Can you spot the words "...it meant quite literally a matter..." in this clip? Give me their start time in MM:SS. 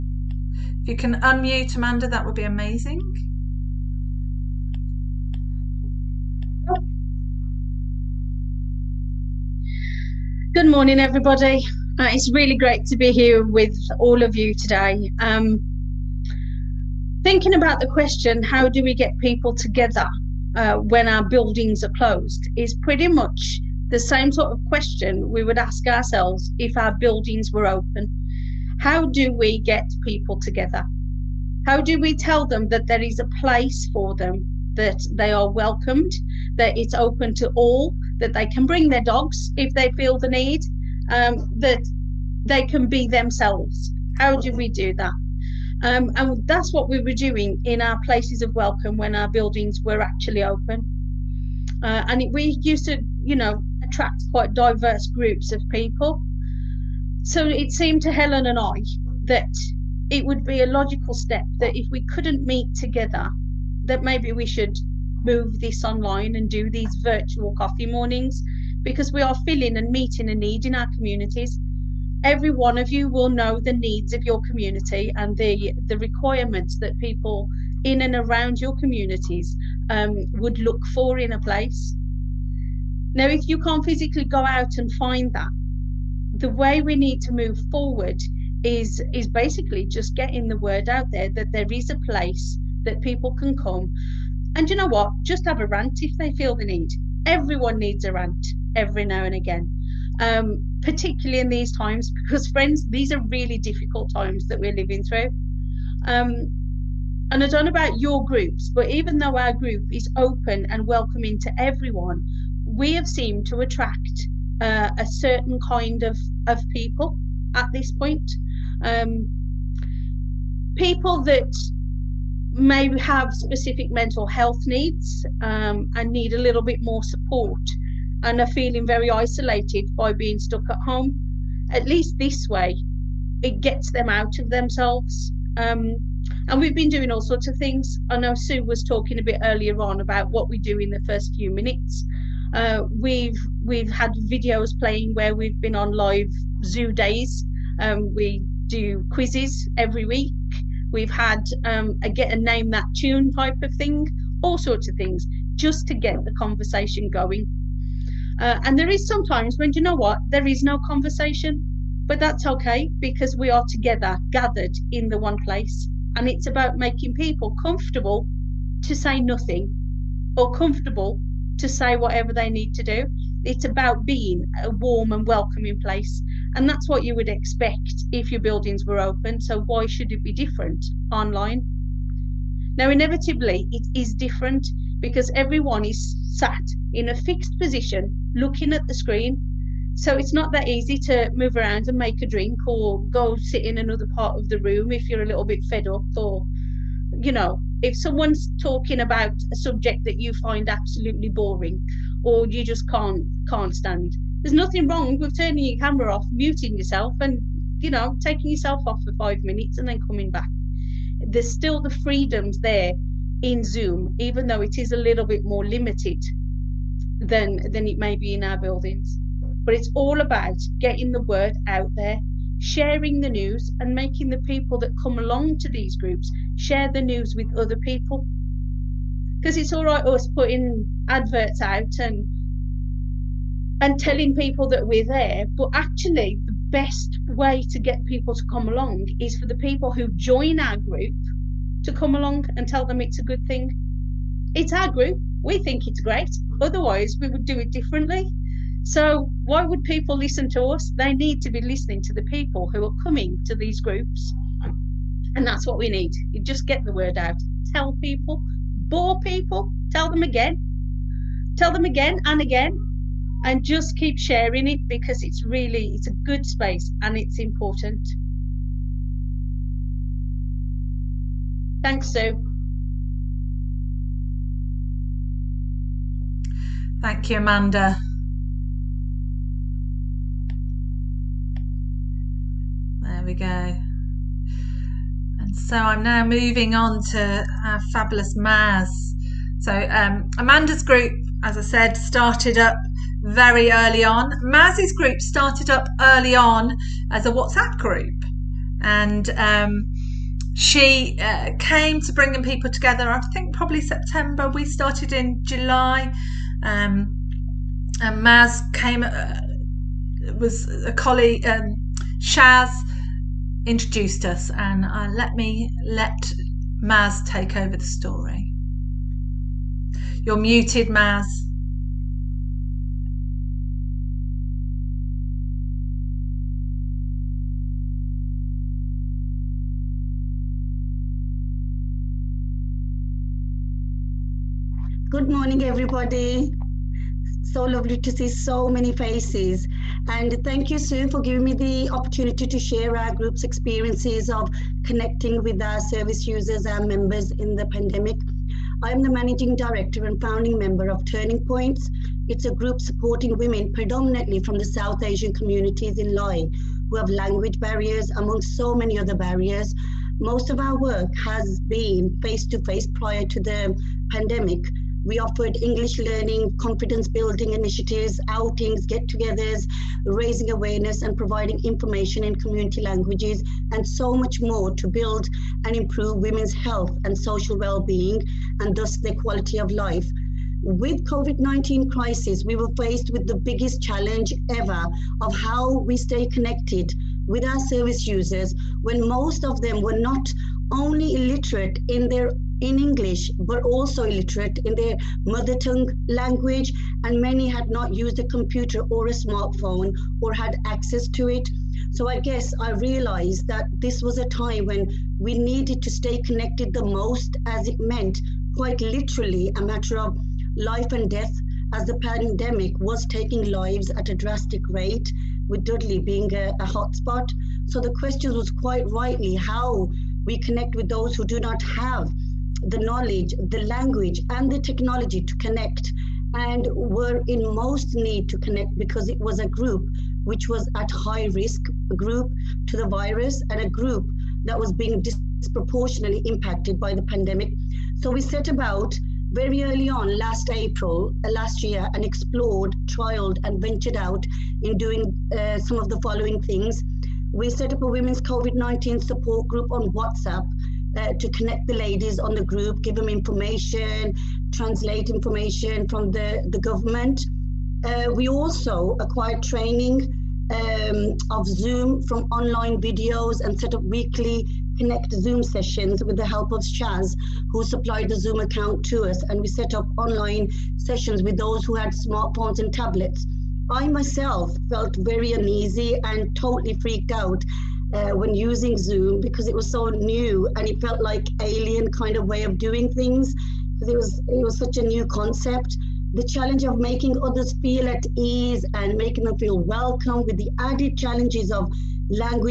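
06:47.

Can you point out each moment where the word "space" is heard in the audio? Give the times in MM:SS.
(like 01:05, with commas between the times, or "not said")
04:26.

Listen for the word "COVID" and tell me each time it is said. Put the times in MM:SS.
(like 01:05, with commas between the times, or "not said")
06:21, 07:28.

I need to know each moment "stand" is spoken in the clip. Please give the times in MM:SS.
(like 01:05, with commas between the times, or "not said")
03:23.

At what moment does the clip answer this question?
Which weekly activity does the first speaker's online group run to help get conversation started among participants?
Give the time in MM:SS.
02:29.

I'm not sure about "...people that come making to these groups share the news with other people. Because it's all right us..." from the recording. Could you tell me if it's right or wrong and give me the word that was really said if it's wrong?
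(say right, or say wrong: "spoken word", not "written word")
wrong: "along", not "making".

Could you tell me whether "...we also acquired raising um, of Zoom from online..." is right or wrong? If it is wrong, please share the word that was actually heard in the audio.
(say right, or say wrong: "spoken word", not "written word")
wrong: "training", not "raising".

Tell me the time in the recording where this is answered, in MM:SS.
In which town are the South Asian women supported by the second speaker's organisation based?
05:56.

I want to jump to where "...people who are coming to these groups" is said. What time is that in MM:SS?
04:12.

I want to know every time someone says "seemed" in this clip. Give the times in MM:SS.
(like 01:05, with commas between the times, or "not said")
00:57, 01:53.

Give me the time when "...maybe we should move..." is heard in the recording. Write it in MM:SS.
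01:04.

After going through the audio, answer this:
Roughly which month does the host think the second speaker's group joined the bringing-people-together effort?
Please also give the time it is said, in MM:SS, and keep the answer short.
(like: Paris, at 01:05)
September, at 05:03.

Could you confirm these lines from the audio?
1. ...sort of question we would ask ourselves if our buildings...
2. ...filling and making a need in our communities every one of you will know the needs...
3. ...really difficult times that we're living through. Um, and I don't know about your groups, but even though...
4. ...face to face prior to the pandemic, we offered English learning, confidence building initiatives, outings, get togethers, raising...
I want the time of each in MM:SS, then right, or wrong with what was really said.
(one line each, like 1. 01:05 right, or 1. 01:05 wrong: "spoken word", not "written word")
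1. 00:24 right
2. 01:09 wrong: "meeting", not "making"
3. 01:43 right
4. 06:02 right.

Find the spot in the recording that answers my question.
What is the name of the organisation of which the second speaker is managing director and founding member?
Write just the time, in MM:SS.
05:51.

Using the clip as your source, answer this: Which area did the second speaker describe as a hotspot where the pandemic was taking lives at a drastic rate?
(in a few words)
Dudley.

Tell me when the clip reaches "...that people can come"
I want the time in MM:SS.
01:32.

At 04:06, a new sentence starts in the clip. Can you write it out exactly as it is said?
Otherwise, we would do it differently.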